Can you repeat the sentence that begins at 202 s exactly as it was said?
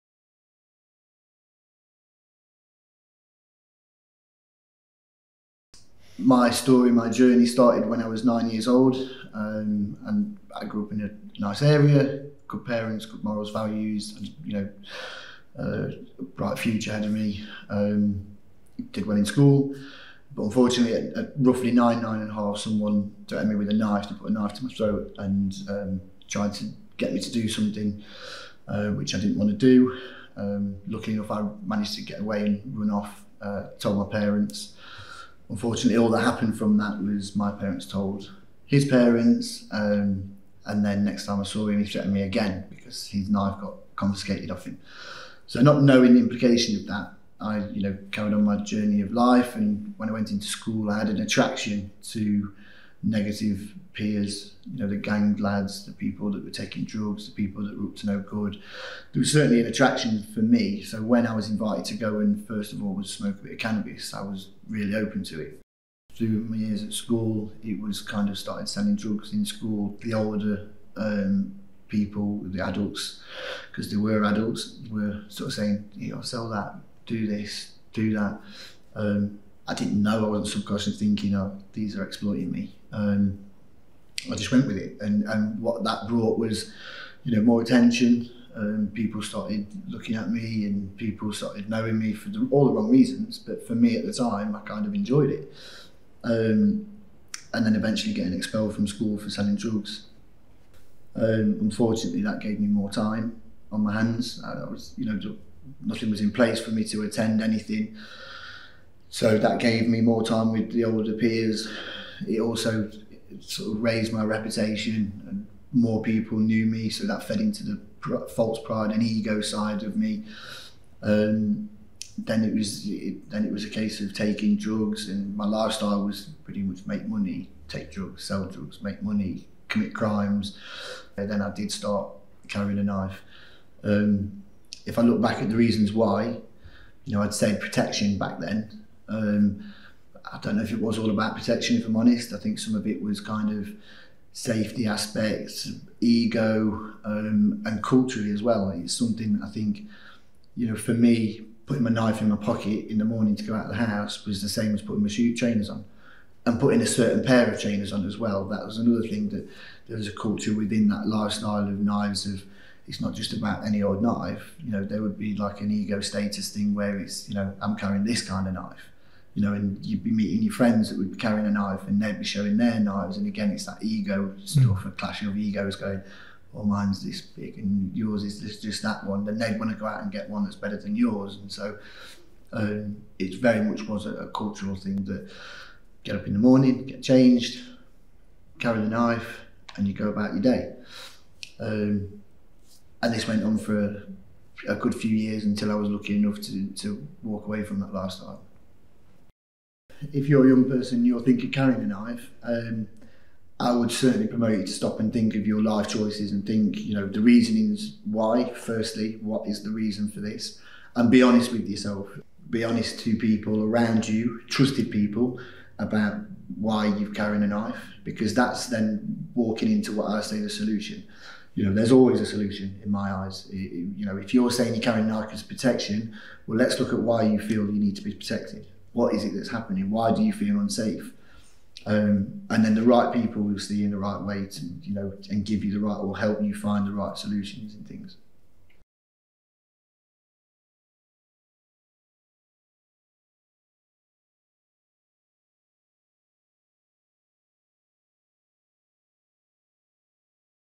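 Um, I would certainly promote you to stop and think of your life choices and think, you know, the reasonings why.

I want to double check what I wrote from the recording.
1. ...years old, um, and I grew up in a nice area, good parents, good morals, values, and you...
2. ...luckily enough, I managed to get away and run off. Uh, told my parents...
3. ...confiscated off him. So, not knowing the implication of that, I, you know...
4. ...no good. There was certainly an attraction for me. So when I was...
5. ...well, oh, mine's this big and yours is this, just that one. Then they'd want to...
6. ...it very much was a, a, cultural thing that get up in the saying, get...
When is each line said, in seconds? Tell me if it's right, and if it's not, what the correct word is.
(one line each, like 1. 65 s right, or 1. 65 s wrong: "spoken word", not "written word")
1. 8 s right
2. 30 s right
3. 43 s right
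4. 58 s right
5. 176 s right
6. 183 s wrong: "morning", not "saying".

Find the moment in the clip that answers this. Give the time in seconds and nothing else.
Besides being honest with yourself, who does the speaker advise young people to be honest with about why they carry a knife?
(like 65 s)
214 s.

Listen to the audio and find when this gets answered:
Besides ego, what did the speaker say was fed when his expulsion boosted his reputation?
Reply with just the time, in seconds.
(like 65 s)
118 s.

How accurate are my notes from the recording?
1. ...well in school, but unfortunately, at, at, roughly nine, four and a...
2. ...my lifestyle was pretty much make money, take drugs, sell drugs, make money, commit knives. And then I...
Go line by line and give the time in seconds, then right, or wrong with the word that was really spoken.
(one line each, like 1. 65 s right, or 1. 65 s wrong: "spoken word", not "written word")
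1. 19 s wrong: "nine", not "four"
2. 125 s wrong: "crimes", not "knives".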